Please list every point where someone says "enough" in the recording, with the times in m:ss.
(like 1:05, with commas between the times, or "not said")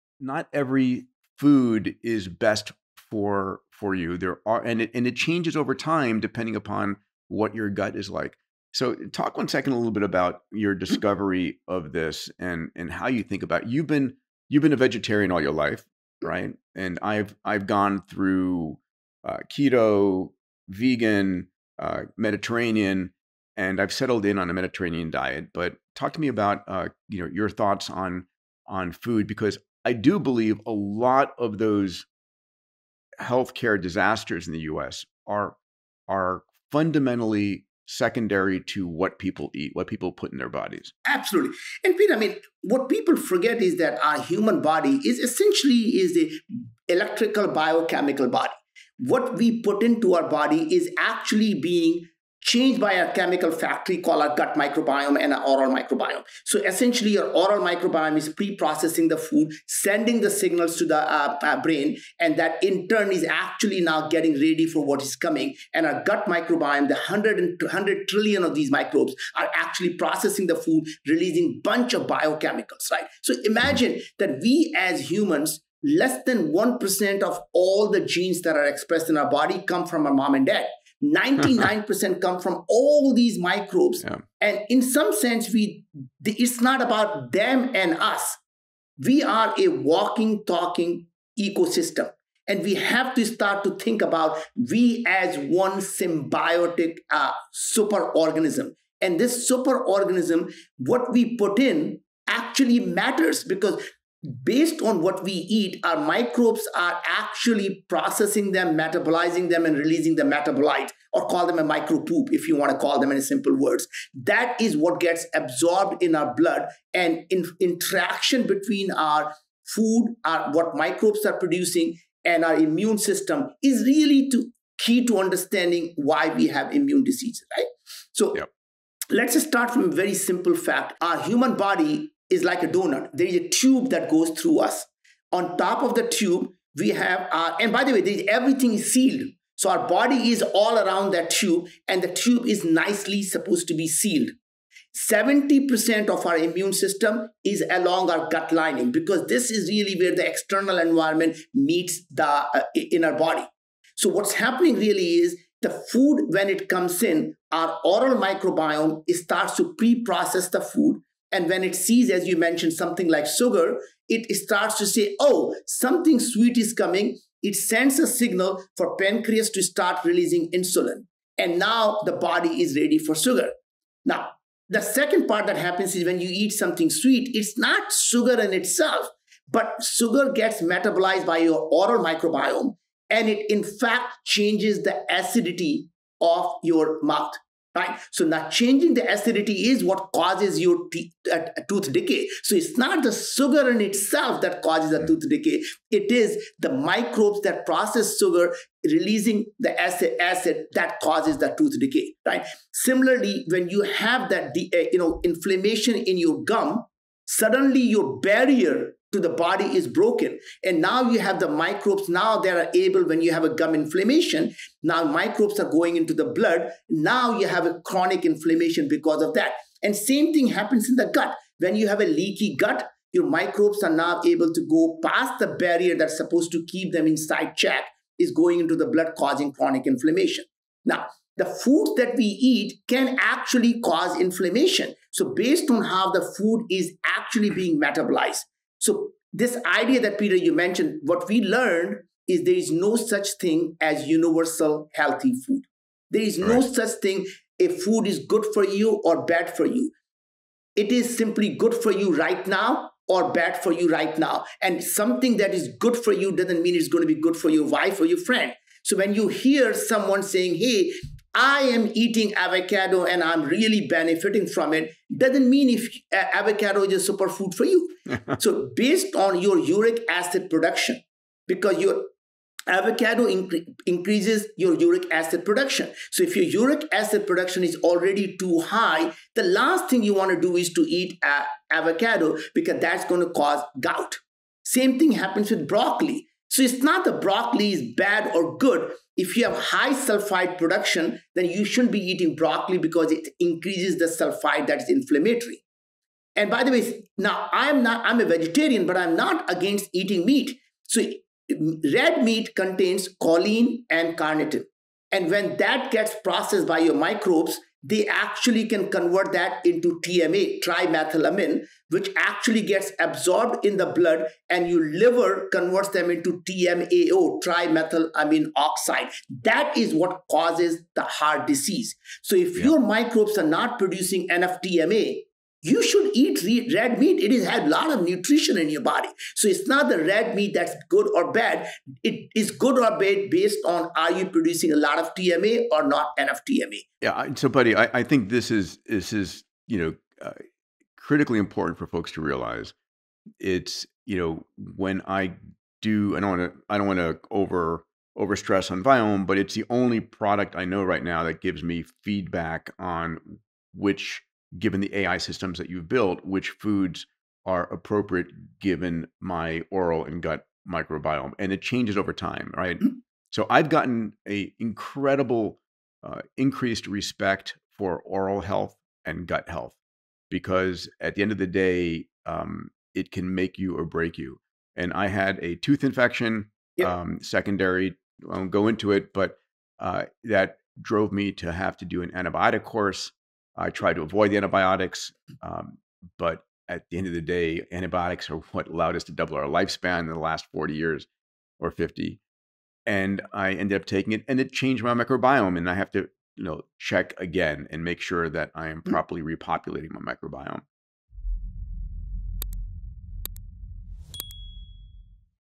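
5:24, 5:36.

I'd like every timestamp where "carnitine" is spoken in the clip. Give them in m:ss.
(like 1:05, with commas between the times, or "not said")
5:04.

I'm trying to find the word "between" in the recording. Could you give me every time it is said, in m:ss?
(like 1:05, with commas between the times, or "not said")
1:58.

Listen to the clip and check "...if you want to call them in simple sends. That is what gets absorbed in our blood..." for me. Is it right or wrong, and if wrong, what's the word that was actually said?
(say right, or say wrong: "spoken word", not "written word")
wrong: "words", not "sends".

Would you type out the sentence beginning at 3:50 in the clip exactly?
Now, the foods that we eat can actually cause inflammation.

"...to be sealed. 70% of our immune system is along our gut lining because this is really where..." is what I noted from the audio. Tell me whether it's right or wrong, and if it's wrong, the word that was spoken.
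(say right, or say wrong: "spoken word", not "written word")
right.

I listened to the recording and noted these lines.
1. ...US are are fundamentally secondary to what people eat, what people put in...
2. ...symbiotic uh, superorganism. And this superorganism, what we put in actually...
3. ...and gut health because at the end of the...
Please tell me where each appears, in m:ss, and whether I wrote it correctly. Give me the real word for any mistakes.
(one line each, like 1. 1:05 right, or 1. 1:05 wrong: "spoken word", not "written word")
1. 0:34 right
2. 1:35 right
3. 6:09 right.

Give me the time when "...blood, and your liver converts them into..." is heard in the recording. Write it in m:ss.
5:13.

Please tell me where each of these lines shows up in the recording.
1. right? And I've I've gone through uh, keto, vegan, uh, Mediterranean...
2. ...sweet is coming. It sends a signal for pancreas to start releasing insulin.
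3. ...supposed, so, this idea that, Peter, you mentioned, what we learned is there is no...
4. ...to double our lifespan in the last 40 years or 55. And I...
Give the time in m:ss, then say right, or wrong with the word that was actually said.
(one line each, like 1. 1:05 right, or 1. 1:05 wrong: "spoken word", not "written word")
1. 0:16 right
2. 2:46 right
3. 3:57 wrong: "metabolized", not "supposed"
4. 6:29 wrong: "50", not "55".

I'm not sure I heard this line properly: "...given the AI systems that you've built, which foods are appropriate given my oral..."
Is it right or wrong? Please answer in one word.
right.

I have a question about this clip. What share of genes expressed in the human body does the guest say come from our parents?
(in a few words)
less than 1%.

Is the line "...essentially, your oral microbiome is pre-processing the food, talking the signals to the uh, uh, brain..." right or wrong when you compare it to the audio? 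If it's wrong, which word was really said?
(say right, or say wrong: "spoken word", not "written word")
wrong: "sending", not "talking".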